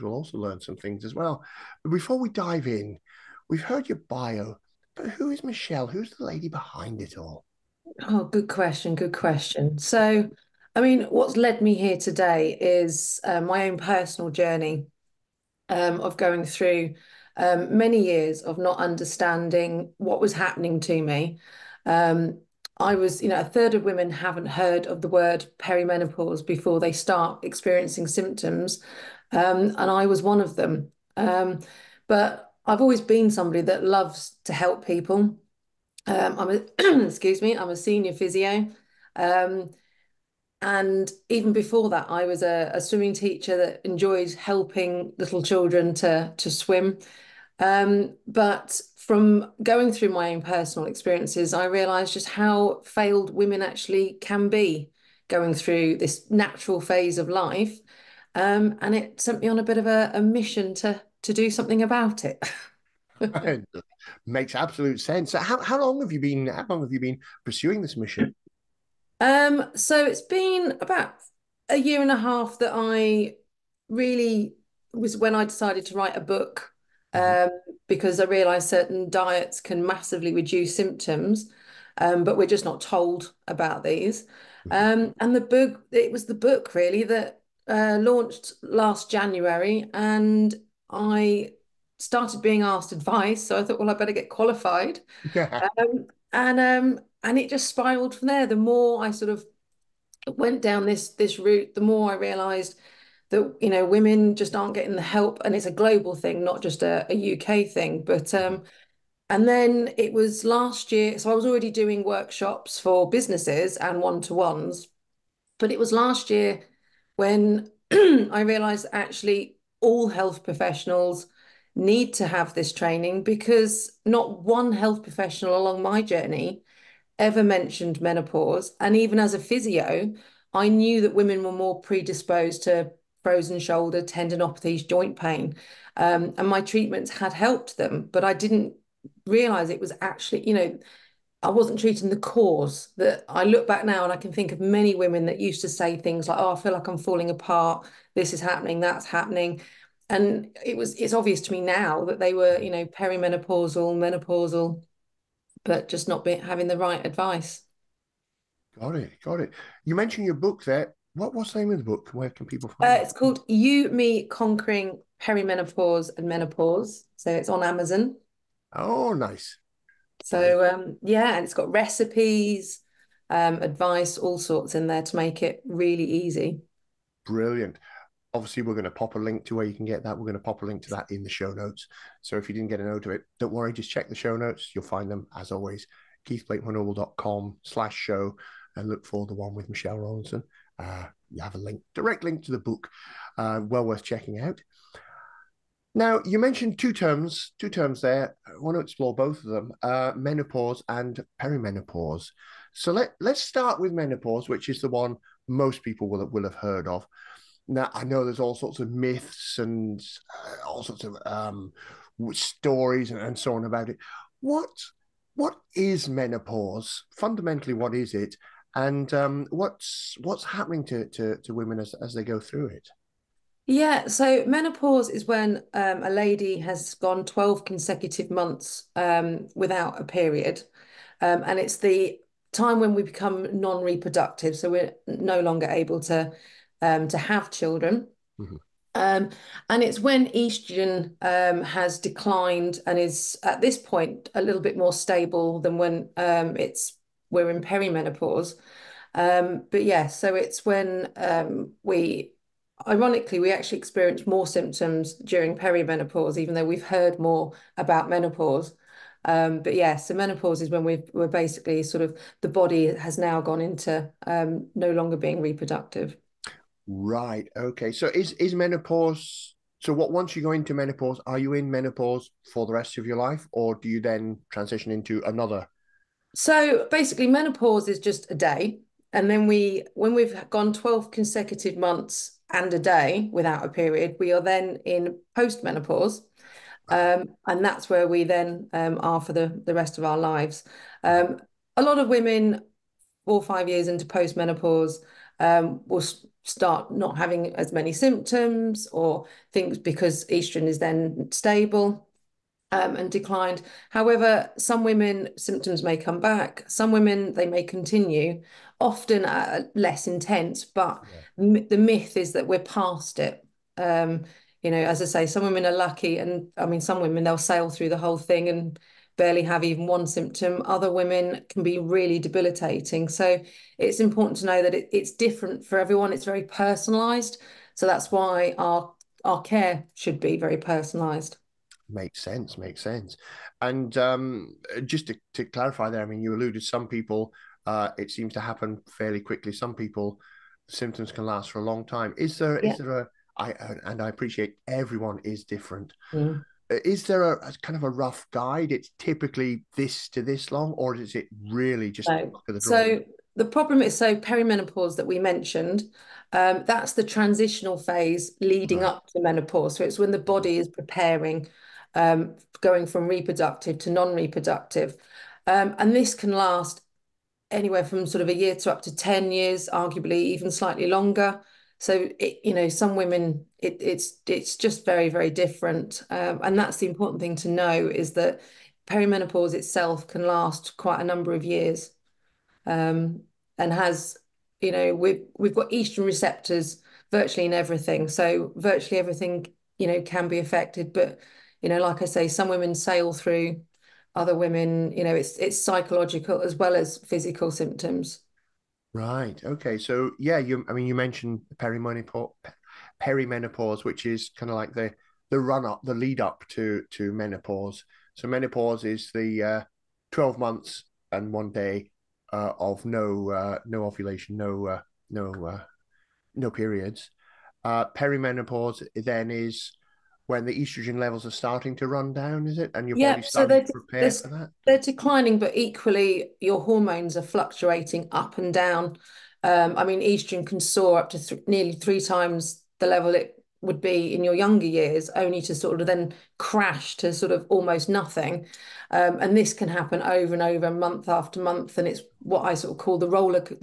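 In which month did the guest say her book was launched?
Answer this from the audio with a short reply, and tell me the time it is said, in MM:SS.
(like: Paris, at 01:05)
January, at 01:29.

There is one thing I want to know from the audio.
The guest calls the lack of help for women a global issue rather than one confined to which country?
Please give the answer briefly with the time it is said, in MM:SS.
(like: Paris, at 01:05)
UK, at 01:47.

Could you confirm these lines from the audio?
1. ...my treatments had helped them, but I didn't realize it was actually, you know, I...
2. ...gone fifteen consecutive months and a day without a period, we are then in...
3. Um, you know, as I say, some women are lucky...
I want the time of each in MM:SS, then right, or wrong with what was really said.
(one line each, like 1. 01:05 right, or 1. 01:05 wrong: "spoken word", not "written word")
1. 02:16 right
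2. 04:40 wrong: "twelve", not "fifteen"
3. 05:13 right.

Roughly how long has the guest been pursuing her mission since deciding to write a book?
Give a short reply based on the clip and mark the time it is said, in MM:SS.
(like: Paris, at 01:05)
a year and a half, at 01:11.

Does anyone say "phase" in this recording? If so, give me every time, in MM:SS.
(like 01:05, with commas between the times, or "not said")
00:56, 05:57.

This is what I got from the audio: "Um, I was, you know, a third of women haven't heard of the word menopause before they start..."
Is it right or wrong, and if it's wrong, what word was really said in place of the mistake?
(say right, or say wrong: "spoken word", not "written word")
wrong: "perimenopause", not "menopause".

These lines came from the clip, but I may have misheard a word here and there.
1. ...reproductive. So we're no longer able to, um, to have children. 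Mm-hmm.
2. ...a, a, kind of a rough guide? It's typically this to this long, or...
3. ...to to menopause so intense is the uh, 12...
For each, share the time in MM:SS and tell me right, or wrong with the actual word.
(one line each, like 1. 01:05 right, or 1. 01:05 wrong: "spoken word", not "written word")
1. 03:53 right
2. 05:47 right
3. 06:46 wrong: "menopause", not "intense".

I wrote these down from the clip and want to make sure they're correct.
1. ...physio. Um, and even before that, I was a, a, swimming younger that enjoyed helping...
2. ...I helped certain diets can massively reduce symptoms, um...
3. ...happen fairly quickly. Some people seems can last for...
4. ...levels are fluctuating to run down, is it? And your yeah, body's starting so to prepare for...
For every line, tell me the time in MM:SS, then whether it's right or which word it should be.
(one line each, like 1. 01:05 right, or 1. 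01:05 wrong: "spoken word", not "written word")
1. 00:38 wrong: "teacher", not "younger"
2. 01:18 wrong: "realized", not "helped"
3. 05:38 wrong: "symptoms", not "seems"
4. 07:00 wrong: "starting", not "fluctuating".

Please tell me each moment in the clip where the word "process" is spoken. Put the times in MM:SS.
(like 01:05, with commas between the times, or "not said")
not said.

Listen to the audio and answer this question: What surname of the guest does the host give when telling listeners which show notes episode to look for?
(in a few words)
Rowlinson.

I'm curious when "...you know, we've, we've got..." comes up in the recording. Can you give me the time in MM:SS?
06:24.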